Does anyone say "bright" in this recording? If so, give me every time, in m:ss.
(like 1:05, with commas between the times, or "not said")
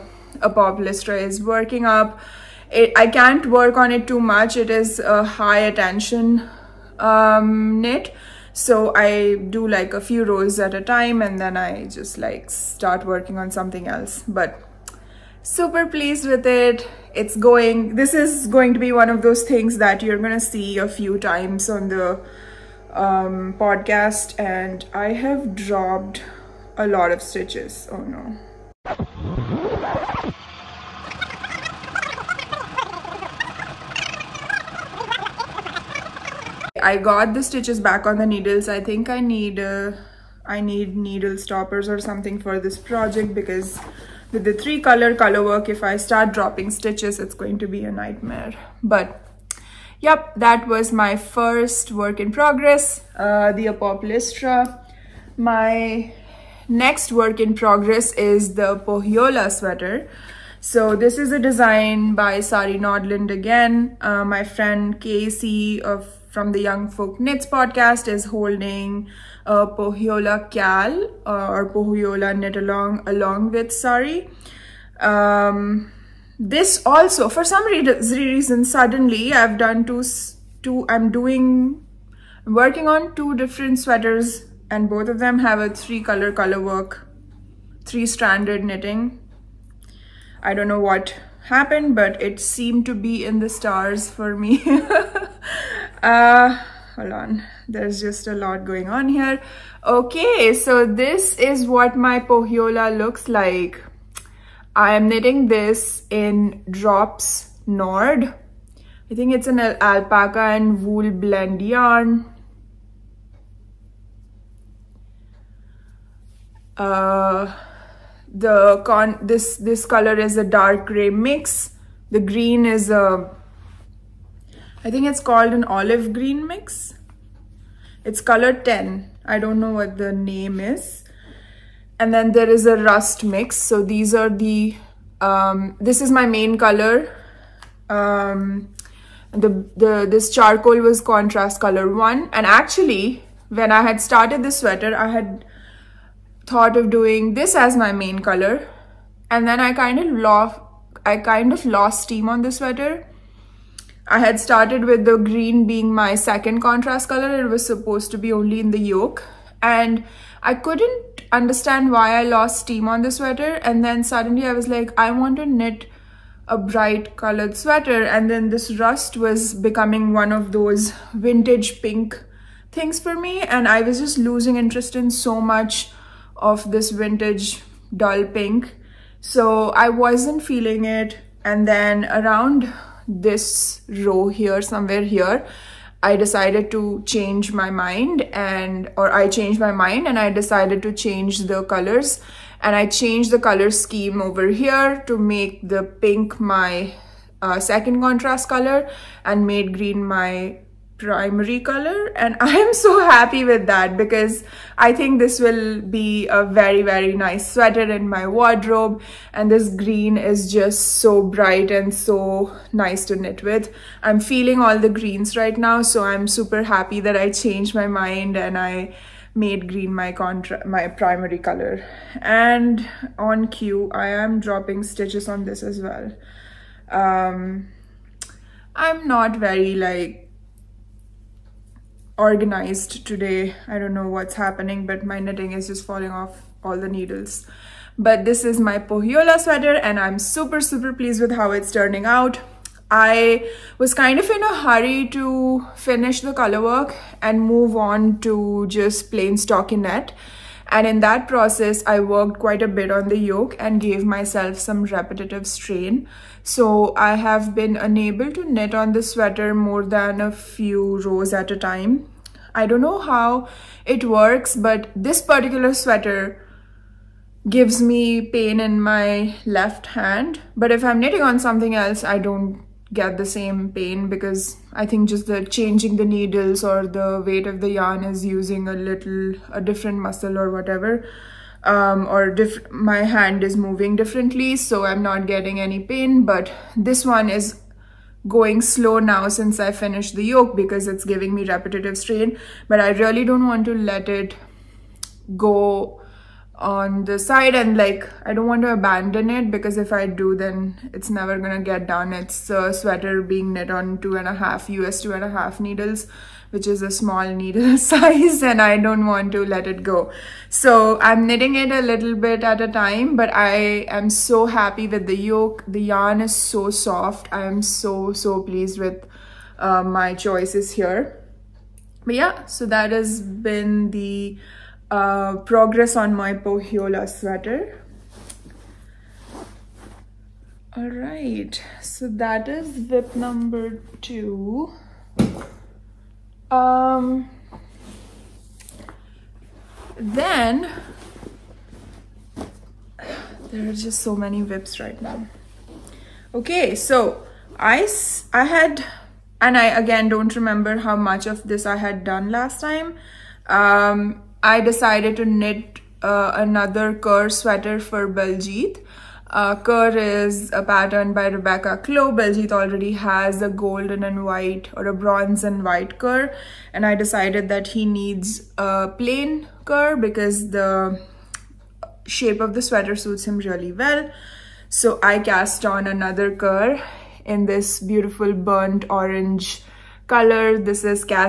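2:46, 3:31.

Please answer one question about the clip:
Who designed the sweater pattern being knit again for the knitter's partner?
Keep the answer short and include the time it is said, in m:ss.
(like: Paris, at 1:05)
Rebecca Clow, at 6:01.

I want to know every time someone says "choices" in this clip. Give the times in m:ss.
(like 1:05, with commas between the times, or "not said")
5:20.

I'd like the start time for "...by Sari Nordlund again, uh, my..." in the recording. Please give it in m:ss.
1:02.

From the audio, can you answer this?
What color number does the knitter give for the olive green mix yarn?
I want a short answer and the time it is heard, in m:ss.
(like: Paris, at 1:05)
10, at 2:08.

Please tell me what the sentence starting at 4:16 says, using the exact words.
So I have been unable to knit on the sweater more than a few rows at a time.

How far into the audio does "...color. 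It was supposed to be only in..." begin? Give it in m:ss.
2:37.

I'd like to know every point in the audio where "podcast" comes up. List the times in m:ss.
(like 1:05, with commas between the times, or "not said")
0:23, 1:07.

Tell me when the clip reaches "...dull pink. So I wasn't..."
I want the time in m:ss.
2:57.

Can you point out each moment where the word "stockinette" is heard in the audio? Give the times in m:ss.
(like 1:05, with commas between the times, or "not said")
4:09.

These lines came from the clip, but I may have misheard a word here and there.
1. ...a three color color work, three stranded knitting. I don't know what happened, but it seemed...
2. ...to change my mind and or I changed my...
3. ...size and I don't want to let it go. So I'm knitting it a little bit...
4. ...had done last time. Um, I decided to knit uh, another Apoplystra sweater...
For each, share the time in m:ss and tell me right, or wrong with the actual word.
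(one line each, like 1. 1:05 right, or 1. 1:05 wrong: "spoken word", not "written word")
1. 1:25 right
2. 3:06 right
3. 5:07 right
4. 5:51 wrong: "Kerr", not "Apoplystra".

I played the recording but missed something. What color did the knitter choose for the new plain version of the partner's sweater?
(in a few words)
burnt orange.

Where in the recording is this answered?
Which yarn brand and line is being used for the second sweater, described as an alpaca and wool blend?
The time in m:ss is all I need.
1:46.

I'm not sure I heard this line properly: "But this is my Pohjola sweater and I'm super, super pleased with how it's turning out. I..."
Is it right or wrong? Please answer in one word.
right.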